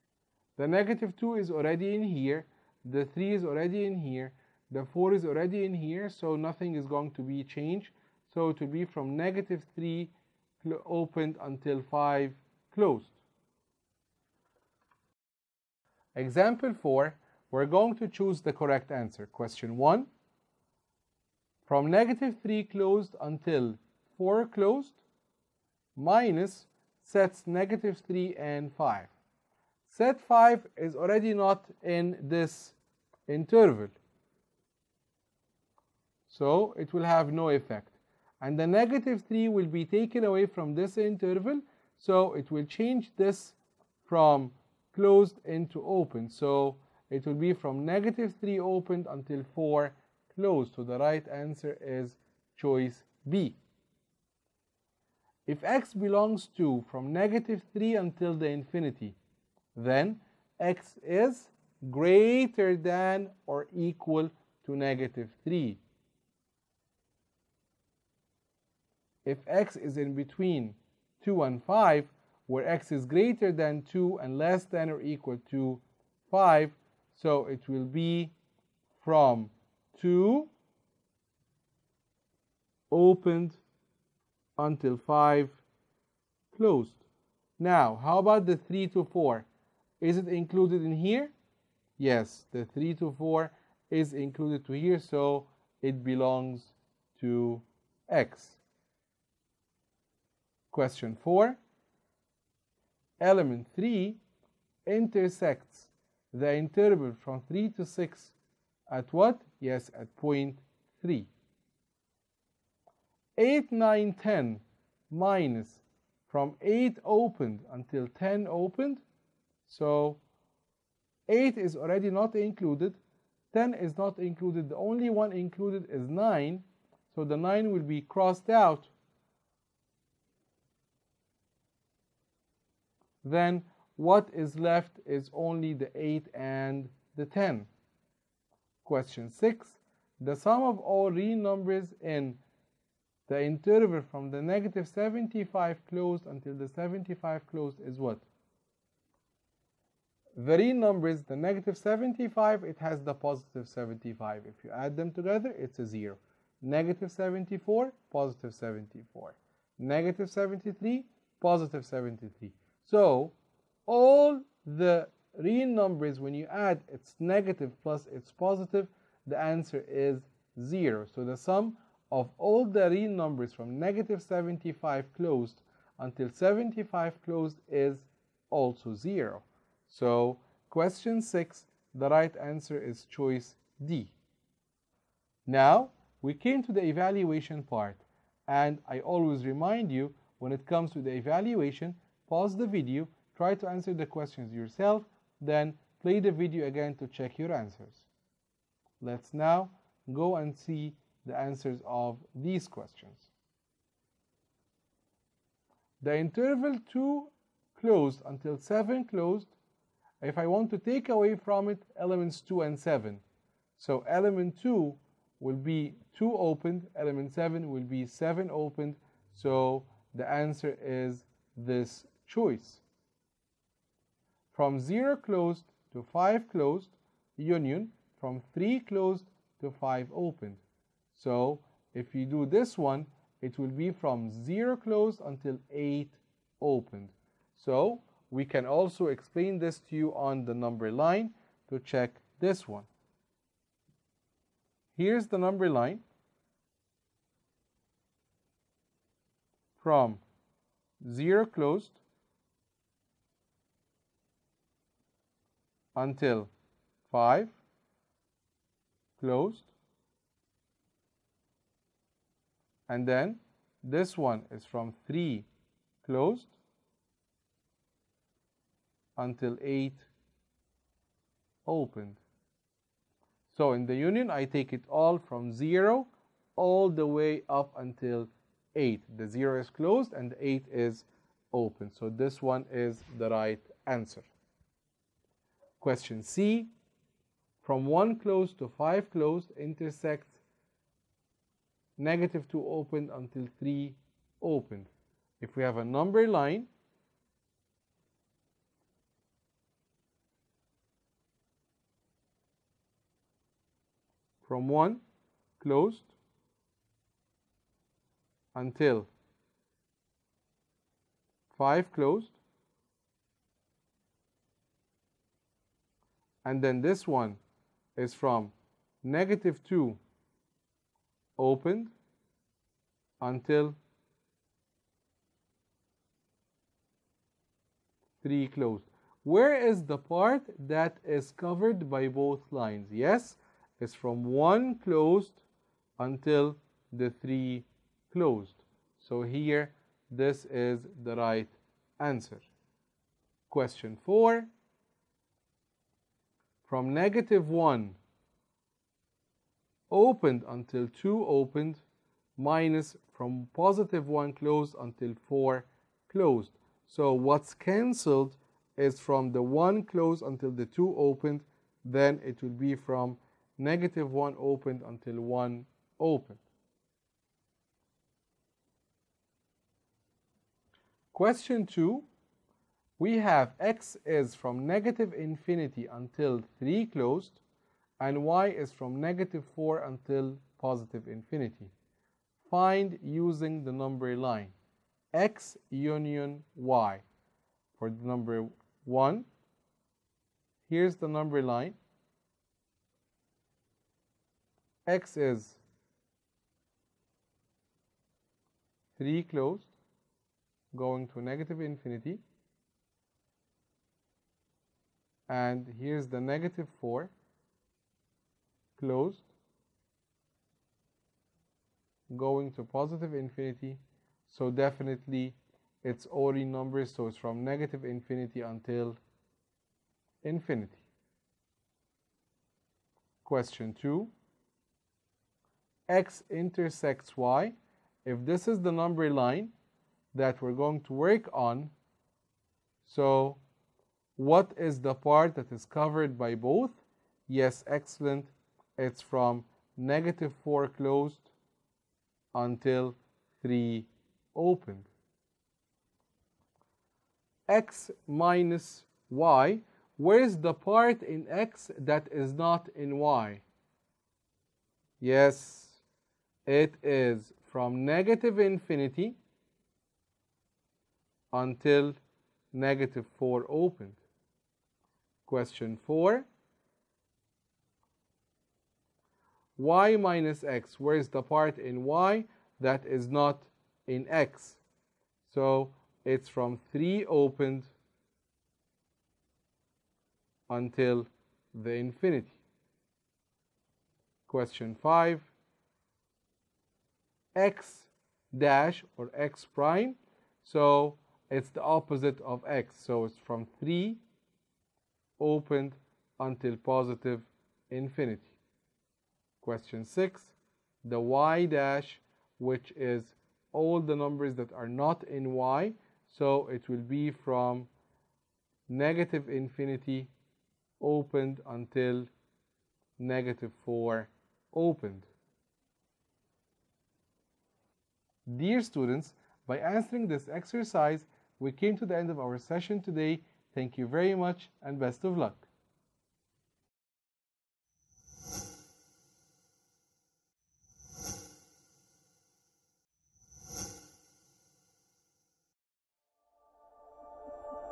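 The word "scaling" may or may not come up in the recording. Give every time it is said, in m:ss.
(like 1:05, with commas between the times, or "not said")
not said.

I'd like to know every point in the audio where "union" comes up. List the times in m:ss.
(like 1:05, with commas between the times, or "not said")
3:47, 4:33, 6:25.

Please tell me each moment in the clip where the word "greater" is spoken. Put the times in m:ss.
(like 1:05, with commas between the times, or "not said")
1:01, 1:13.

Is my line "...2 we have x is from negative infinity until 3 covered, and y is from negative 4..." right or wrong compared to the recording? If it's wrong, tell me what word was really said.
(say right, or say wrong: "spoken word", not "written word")
wrong: "closed", not "covered".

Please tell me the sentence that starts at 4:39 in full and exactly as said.
The 0 is closed and the 8 is open.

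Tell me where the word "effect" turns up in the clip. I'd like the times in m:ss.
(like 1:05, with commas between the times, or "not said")
0:37.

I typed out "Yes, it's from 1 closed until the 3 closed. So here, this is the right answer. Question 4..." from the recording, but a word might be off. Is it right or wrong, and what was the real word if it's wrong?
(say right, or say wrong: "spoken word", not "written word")
right.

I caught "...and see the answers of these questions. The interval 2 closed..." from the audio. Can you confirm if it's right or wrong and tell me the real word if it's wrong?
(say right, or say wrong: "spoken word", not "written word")
right.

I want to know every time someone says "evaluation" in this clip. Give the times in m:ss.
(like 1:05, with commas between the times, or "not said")
3:06, 3:11.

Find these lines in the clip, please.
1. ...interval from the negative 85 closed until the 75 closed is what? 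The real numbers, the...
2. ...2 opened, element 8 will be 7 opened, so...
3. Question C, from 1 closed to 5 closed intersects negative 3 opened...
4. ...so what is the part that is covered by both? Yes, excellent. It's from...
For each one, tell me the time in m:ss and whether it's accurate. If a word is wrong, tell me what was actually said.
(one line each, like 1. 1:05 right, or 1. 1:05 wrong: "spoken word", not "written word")
1. 2:23 wrong: "75", not "85"
2. 3:36 wrong: "7", not "8"
3. 4:45 wrong: "2", not "3"
4. 7:12 right.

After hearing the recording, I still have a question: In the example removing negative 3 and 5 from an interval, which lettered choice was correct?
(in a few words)
B.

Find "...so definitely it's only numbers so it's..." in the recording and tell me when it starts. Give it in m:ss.
6:54.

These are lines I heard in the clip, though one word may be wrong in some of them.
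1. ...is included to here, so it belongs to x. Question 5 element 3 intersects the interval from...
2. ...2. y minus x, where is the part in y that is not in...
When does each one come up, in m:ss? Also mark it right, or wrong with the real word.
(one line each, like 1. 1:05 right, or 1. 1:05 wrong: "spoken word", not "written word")
1. 1:33 wrong: "4", not "5"
2. 7:45 wrong: "4", not "2".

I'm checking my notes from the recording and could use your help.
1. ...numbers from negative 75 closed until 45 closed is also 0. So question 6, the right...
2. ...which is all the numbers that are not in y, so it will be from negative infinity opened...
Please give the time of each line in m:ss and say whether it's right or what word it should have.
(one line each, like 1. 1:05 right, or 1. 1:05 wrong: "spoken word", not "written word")
1. 2:53 wrong: "75", not "45"
2. 8:22 right.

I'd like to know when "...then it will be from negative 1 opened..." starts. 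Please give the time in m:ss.
6:01.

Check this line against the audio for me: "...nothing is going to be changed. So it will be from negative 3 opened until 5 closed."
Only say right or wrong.
right.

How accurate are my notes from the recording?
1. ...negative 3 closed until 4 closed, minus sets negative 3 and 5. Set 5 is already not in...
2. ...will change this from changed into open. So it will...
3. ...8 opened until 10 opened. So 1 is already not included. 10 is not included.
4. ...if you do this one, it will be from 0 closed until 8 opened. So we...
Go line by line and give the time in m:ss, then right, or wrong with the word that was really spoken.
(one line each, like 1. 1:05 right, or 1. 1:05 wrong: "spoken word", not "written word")
1. 0:21 right
2. 0:42 wrong: "closed", not "changed"
3. 1:56 wrong: "8", not "1"
4. 3:51 right.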